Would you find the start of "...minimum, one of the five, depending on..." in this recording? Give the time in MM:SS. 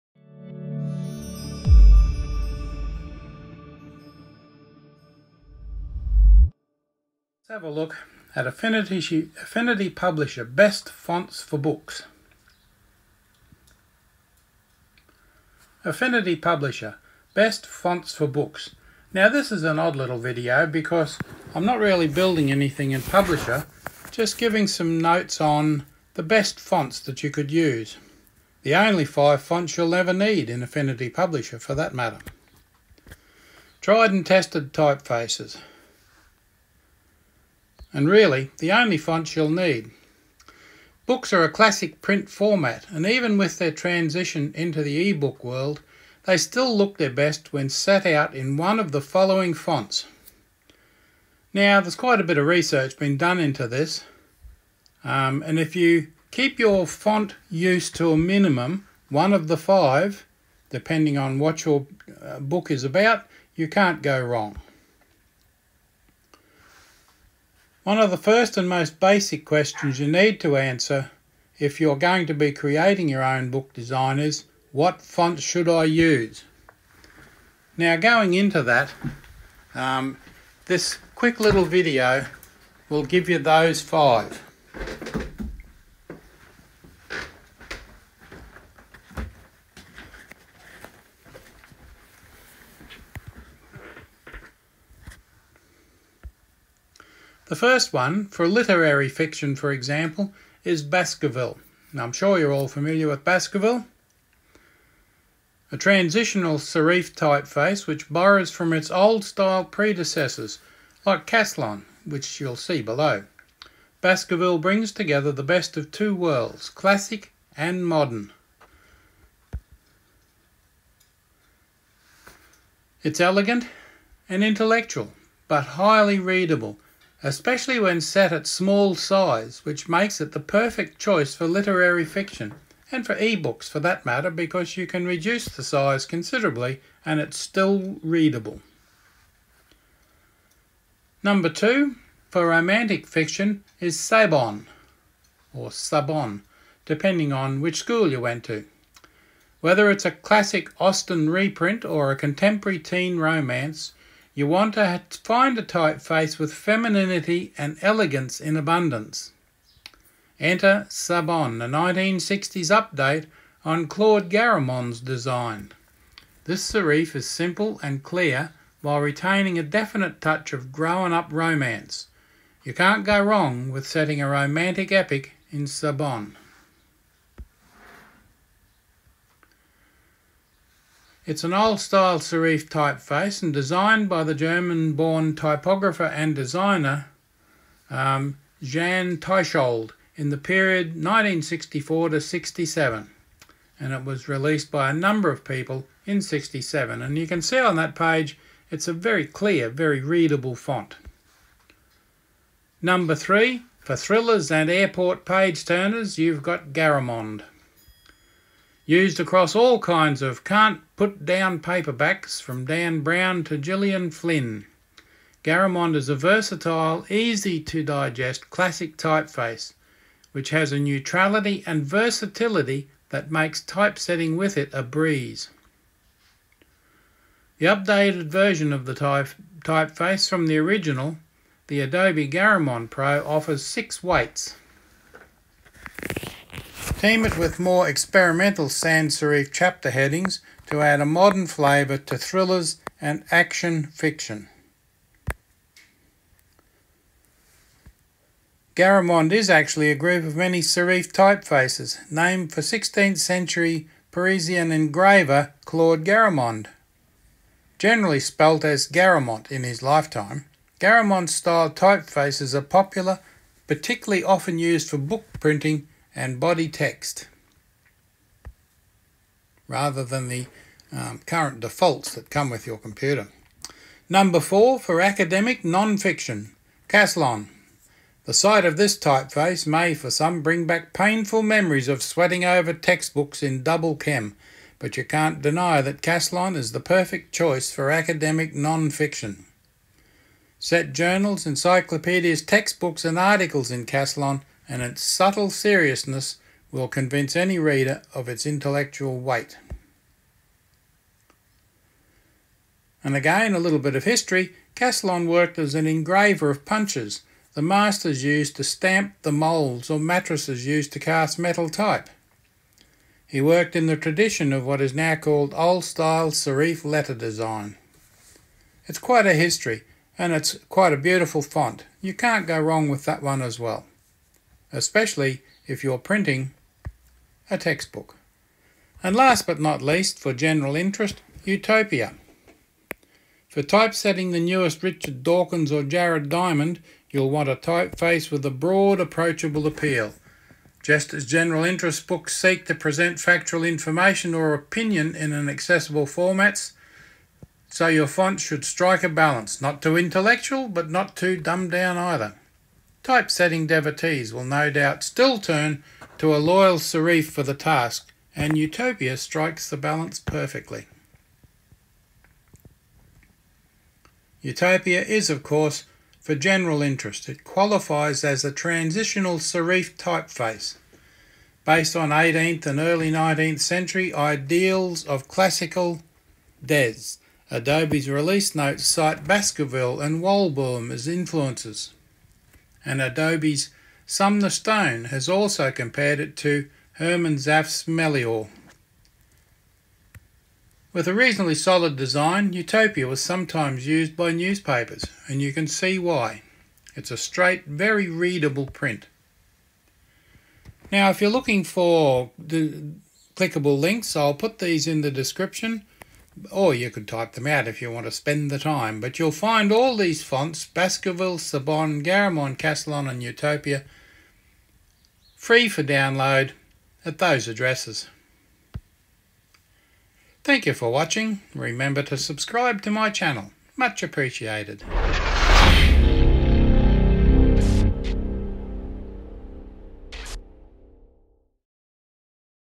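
00:58.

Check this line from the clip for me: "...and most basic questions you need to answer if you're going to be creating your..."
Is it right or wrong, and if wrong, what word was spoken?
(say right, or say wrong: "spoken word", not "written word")
right.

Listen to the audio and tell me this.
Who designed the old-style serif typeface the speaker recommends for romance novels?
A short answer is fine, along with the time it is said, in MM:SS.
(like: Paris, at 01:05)
Jan Tschichold, at 03:08.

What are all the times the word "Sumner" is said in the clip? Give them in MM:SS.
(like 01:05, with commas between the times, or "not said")
06:24.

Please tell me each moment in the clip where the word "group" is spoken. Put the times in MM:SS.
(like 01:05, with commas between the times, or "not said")
04:09.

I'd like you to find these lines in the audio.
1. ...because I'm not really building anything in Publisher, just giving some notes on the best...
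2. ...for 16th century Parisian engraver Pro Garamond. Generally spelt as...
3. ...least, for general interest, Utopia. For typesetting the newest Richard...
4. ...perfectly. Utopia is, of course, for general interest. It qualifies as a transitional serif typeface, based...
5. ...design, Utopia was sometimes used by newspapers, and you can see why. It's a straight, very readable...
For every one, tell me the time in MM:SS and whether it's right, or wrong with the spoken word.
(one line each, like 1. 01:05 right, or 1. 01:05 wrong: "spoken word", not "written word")
1. 00:20 right
2. 04:12 wrong: "Claude", not "Pro"
3. 05:29 right
4. 06:00 right
5. 06:31 right.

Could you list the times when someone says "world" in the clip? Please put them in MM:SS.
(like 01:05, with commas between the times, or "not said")
00:45, 01:56.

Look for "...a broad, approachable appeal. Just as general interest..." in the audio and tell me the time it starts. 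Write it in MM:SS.
05:38.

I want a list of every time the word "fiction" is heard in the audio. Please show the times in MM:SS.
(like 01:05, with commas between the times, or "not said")
01:39, 02:12, 02:23, 04:03, 04:35, 04:48.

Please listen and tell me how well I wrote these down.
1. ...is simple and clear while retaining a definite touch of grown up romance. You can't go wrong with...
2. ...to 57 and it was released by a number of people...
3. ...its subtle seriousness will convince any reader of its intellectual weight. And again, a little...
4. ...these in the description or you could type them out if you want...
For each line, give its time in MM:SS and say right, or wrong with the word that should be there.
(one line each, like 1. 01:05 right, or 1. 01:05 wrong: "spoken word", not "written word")
1. 02:47 right
2. 03:12 wrong: "67", not "57"
3. 04:54 right
4. 06:44 right.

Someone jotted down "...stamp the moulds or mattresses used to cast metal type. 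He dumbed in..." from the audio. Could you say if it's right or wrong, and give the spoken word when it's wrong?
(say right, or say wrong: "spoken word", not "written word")
wrong: "worked", not "dumbed".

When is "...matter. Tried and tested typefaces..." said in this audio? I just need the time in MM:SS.
00:31.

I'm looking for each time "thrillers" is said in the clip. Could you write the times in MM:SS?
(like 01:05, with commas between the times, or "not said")
03:23, 04:02.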